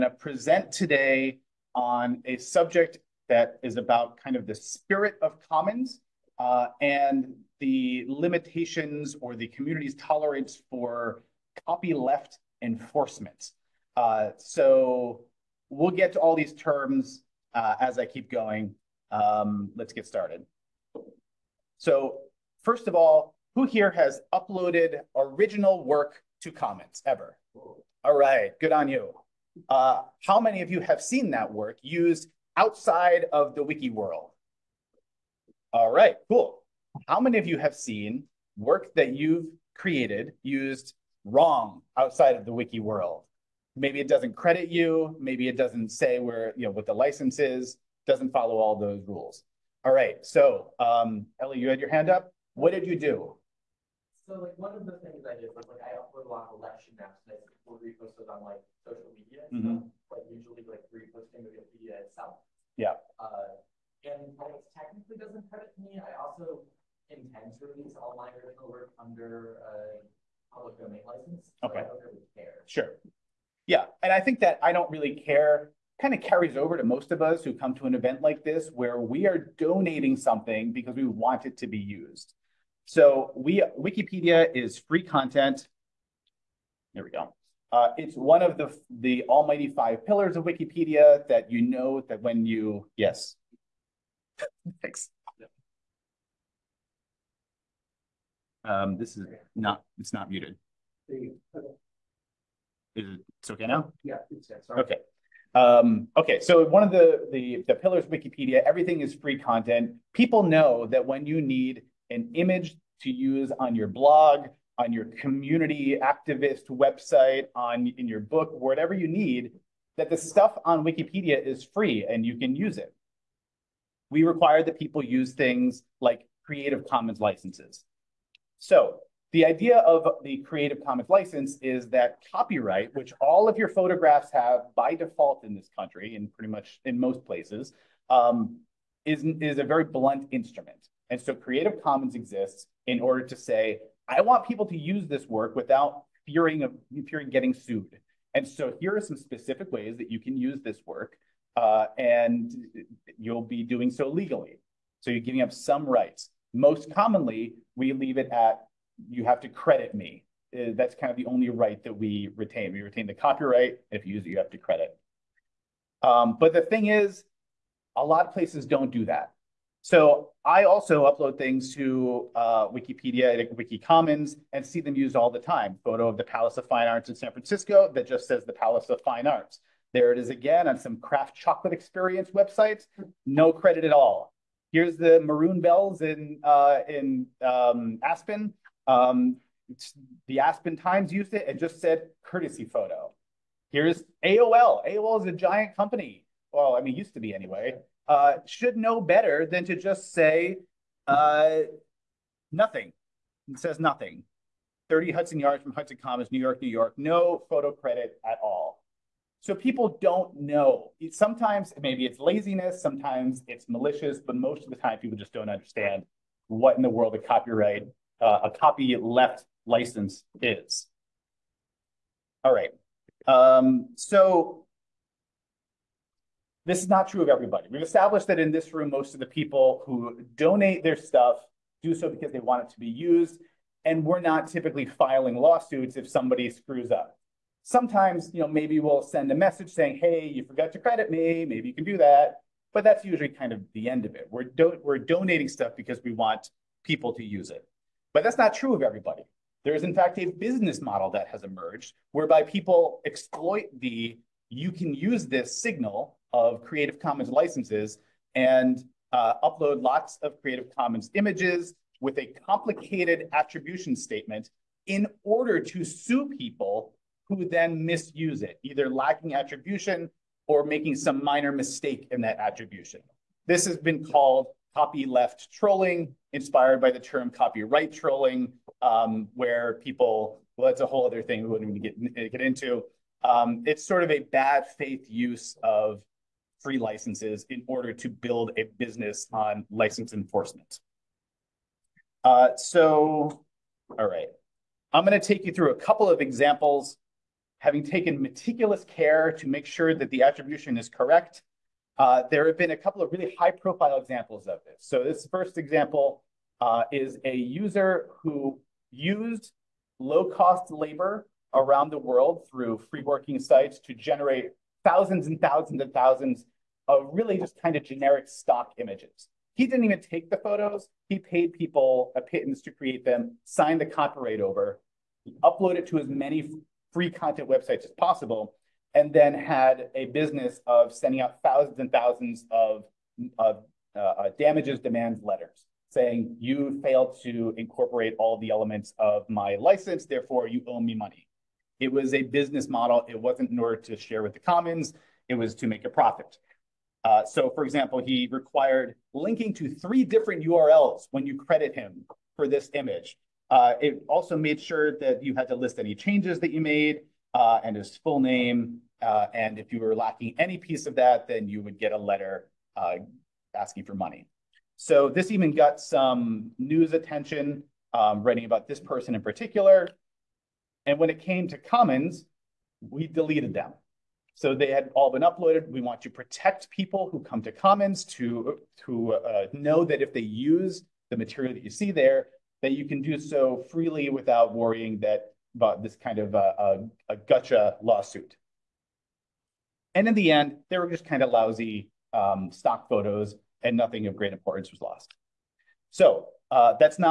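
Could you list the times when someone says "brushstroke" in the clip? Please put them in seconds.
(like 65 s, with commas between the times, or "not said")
not said.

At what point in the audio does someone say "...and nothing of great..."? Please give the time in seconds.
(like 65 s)
393 s.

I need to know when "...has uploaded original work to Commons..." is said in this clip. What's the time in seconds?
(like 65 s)
23 s.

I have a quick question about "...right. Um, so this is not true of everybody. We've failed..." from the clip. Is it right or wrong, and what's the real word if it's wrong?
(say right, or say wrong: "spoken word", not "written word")
wrong: "established", not "failed".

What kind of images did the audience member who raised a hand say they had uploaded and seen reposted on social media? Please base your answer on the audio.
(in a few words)
Election maps.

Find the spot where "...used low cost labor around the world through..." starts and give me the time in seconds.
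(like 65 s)
308 s.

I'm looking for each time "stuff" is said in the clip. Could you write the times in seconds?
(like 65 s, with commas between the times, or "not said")
59 s, 120 s, 230 s, 245 s.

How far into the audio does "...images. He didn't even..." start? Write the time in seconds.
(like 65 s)
318 s.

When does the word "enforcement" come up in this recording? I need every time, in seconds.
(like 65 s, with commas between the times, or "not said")
12 s, 290 s.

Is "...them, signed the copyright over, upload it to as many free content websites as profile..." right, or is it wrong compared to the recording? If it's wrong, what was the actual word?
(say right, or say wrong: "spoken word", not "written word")
wrong: "possible", not "profile".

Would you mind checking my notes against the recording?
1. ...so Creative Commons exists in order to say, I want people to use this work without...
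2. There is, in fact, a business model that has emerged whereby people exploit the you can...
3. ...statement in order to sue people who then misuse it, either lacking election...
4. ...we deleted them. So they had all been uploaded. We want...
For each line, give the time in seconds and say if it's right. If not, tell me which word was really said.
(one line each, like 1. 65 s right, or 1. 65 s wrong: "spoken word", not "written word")
1. 141 s right
2. 249 s right
3. 263 s wrong: "attribution", not "election"
4. 372 s right.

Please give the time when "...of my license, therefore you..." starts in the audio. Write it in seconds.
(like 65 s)
338 s.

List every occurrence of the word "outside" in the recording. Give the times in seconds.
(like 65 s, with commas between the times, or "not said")
32 s, 41 s.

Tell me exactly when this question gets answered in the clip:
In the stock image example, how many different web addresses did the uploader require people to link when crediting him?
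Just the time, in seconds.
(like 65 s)
349 s.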